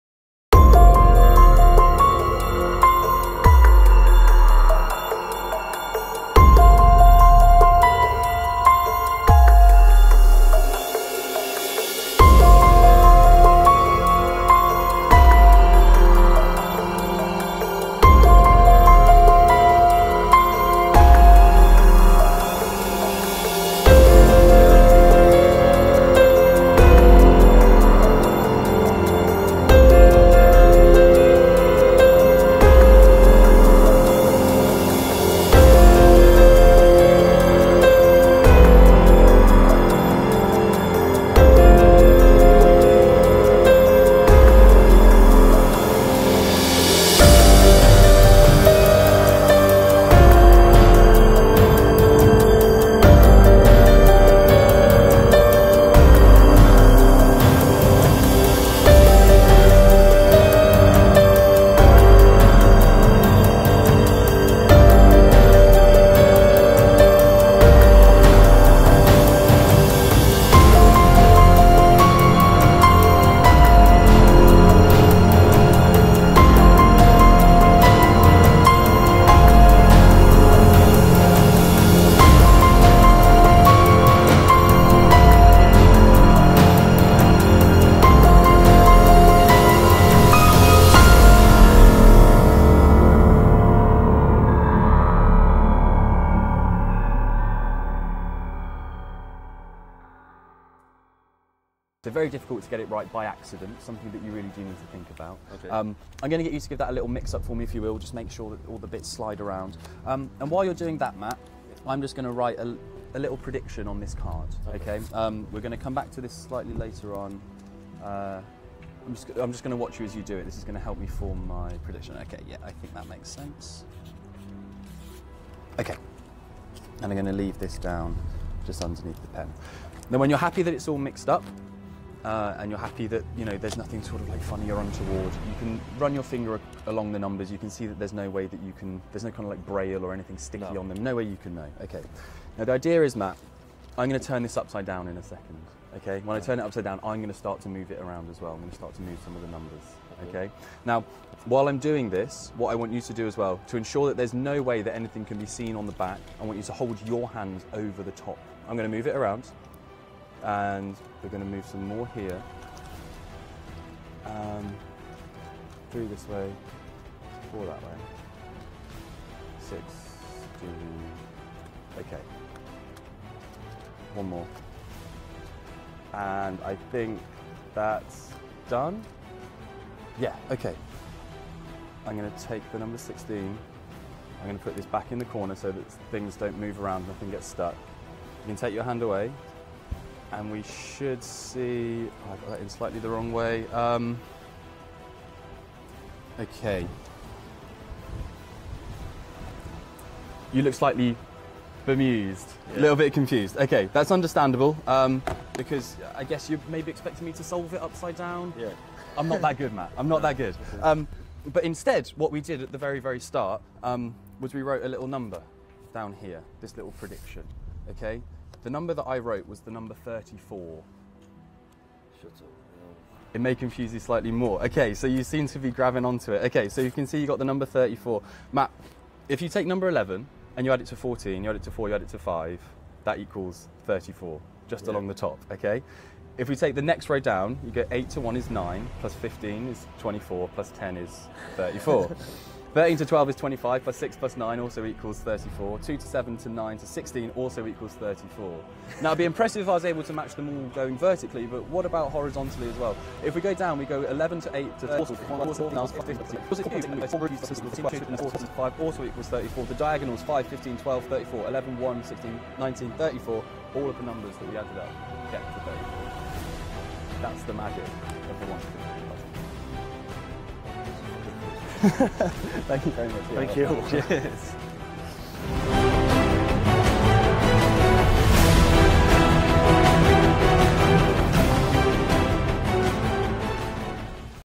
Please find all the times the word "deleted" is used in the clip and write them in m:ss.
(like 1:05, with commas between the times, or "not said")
not said.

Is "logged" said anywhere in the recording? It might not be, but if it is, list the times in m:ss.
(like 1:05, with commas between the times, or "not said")
not said.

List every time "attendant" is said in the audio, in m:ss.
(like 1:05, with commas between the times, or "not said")
not said.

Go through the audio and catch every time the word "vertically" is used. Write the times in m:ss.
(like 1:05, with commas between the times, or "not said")
4:10.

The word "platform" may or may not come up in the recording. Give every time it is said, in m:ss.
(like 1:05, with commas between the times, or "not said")
not said.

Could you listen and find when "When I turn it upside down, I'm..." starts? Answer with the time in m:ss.
2:26.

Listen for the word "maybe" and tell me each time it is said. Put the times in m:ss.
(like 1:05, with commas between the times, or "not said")
3:26.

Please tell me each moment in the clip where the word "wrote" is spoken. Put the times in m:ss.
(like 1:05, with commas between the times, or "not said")
3:34, 3:39.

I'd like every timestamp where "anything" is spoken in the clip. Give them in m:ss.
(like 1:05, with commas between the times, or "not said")
2:20, 2:34.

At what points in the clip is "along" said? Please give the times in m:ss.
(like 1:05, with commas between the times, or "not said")
2:16, 3:54.